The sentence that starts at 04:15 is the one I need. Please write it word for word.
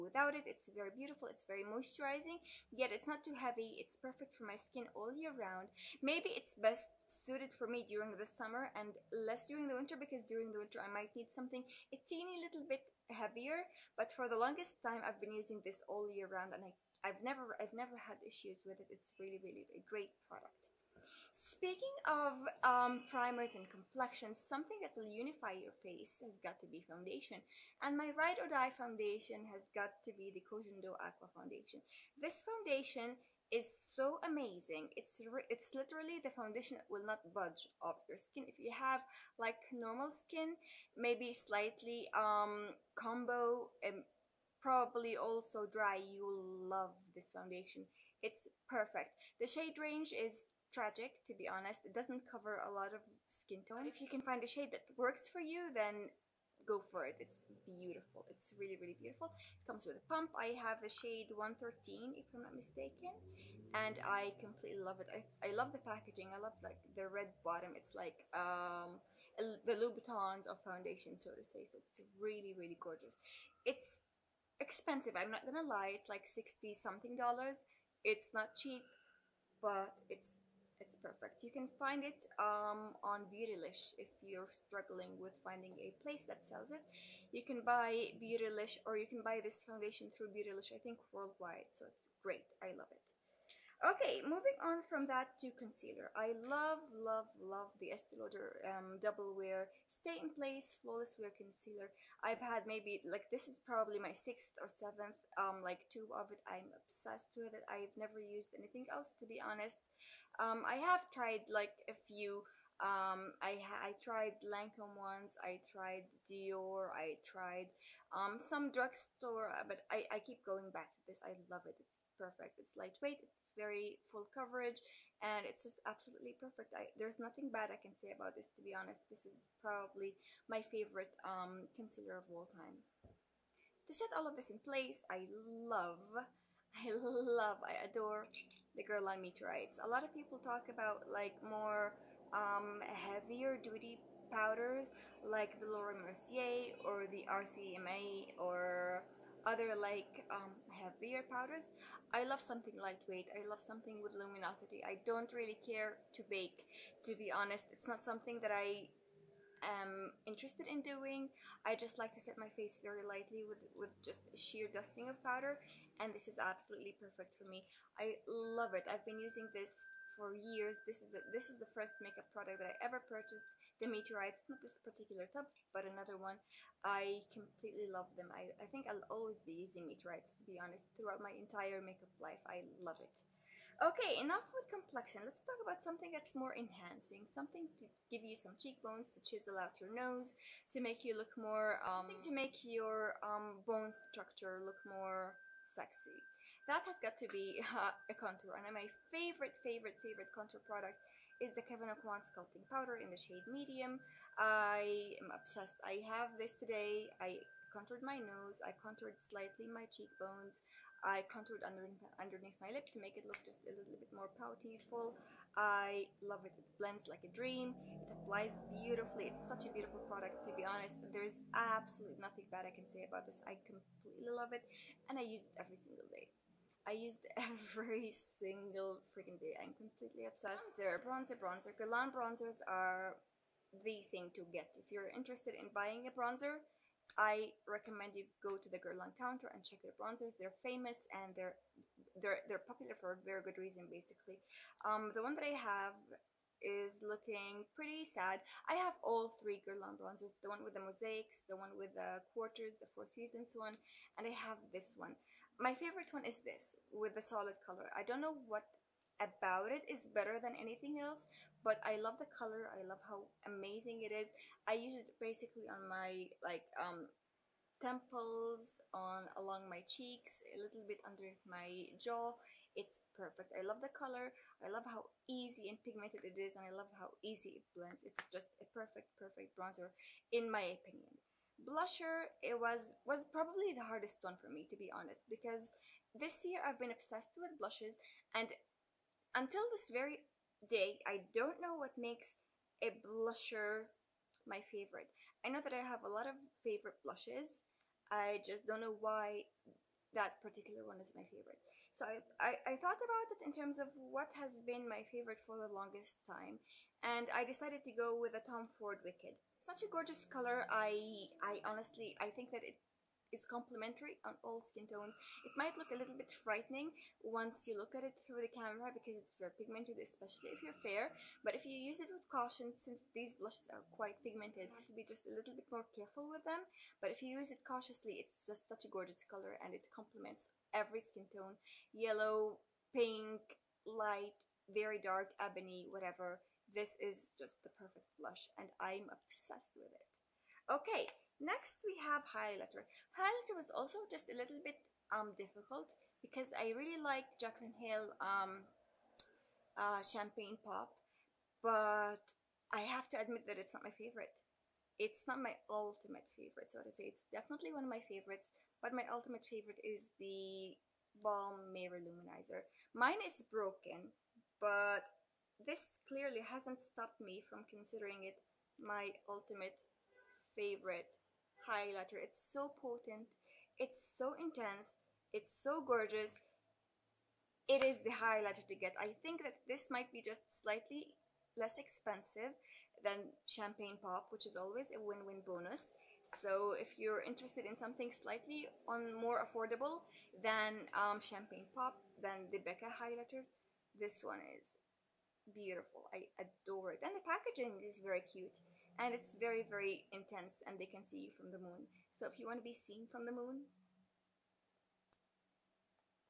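My favorite one is this, with the solid color.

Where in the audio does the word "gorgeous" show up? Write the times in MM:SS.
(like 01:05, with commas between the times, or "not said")
01:12, 05:09, 05:28, 06:15.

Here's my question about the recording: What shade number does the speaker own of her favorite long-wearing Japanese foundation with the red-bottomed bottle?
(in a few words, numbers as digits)
113.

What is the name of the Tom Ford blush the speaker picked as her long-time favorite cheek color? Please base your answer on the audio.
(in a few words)
Wicked.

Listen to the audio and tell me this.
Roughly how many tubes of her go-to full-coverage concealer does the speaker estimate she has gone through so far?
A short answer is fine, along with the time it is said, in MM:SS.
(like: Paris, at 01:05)
6 or 7, at 01:44.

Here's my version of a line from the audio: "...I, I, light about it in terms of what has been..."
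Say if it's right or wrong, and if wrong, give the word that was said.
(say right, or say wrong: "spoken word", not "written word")
wrong: "thought", not "light".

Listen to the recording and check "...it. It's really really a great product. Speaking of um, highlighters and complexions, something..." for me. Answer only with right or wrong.
wrong.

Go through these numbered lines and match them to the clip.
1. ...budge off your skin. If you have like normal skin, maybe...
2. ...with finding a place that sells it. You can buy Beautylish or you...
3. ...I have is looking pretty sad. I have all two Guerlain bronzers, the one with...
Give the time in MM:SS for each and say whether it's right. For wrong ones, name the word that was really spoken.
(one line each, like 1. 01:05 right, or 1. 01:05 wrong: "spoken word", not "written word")
1. 00:37 right
2. 01:25 right
3. 04:05 wrong: "three", not "two".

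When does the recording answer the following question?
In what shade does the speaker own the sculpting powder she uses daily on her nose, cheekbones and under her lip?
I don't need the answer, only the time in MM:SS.
03:23.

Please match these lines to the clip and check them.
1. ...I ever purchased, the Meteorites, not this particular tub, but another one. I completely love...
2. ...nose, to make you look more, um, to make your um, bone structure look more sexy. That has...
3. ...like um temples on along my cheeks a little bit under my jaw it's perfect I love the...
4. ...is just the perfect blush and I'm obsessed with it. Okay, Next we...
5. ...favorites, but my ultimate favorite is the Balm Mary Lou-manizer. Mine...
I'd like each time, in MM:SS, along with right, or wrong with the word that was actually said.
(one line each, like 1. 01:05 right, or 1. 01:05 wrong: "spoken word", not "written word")
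1. 02:52 right
2. 03:09 right
3. 04:26 right
4. 05:36 right
5. 05:58 right.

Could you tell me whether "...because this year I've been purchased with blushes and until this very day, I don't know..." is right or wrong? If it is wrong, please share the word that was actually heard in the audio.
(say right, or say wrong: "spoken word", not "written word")
wrong: "obsessed", not "purchased".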